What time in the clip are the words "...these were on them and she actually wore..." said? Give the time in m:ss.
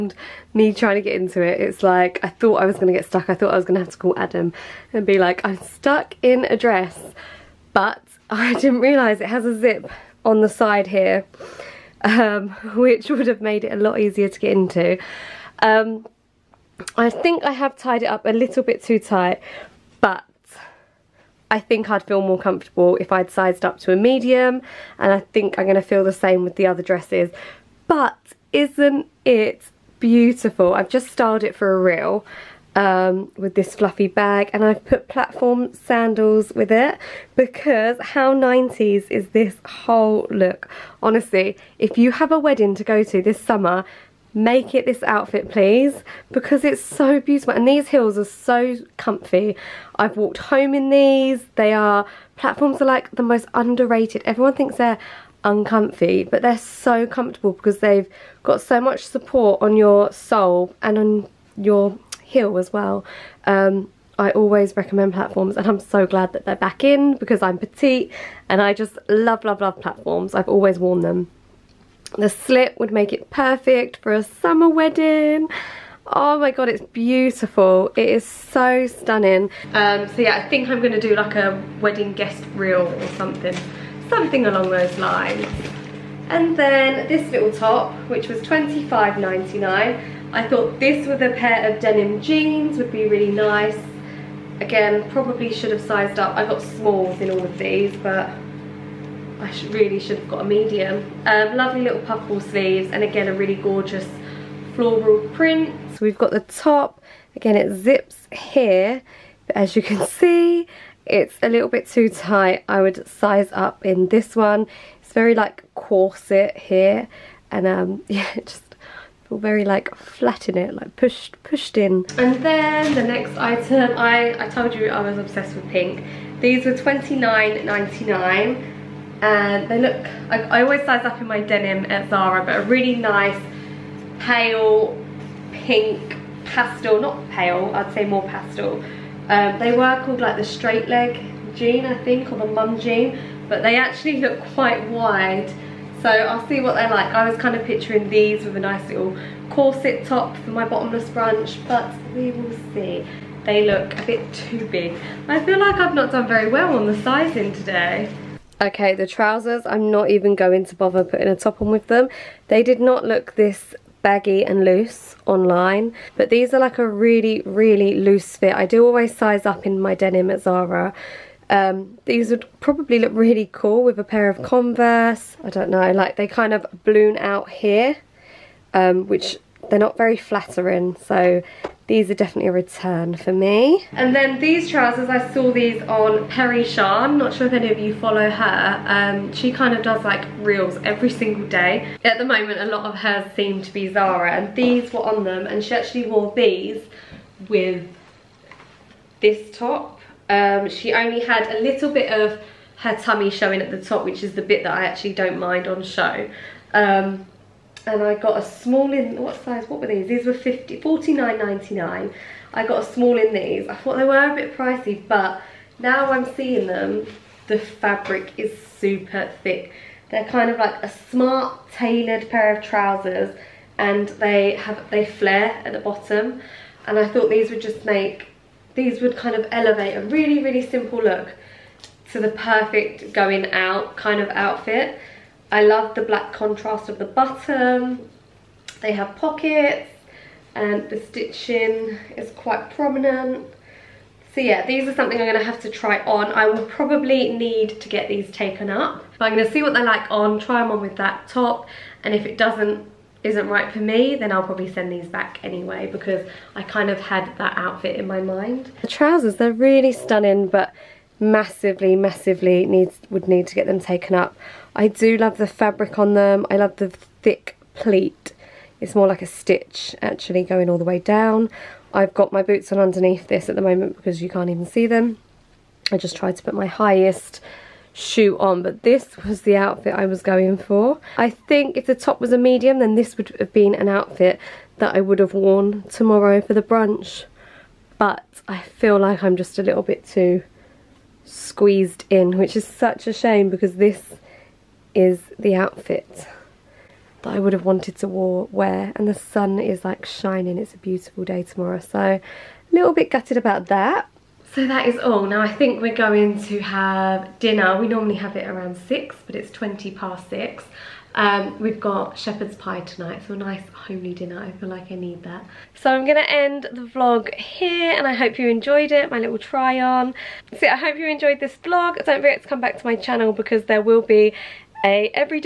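3:14.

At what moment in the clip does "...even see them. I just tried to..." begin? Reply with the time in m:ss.
4:34.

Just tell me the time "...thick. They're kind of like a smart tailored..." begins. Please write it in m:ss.
3:39.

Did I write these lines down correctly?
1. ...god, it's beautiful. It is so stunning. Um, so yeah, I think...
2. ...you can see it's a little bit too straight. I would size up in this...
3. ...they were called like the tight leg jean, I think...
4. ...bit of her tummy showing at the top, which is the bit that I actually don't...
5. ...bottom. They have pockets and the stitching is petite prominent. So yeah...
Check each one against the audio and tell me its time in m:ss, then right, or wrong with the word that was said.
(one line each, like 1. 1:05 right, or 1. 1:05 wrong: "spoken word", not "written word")
1. 1:16 right
2. 1:49 wrong: "tight", not "straight"
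3. 2:19 wrong: "straight", not "tight"
4. 3:21 right
5. 3:57 wrong: "quite", not "petite".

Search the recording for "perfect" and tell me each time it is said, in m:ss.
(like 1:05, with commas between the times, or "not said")
1:13, 3:52.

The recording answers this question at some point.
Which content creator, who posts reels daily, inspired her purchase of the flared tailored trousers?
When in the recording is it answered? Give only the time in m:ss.
3:06.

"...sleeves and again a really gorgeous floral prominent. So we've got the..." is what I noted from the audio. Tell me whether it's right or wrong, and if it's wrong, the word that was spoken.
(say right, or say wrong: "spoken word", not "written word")
wrong: "print", not "prominent".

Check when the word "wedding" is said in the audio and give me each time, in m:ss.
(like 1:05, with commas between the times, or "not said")
0:42, 1:14, 1:21.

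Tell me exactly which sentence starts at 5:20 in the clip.
So I hope you enjoyed this vlog.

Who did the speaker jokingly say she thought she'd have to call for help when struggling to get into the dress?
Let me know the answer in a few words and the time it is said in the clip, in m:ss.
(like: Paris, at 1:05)
Adam, at 0:04.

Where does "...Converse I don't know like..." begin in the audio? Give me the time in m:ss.
2:54.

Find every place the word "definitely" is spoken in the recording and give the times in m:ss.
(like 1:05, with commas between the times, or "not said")
3:02.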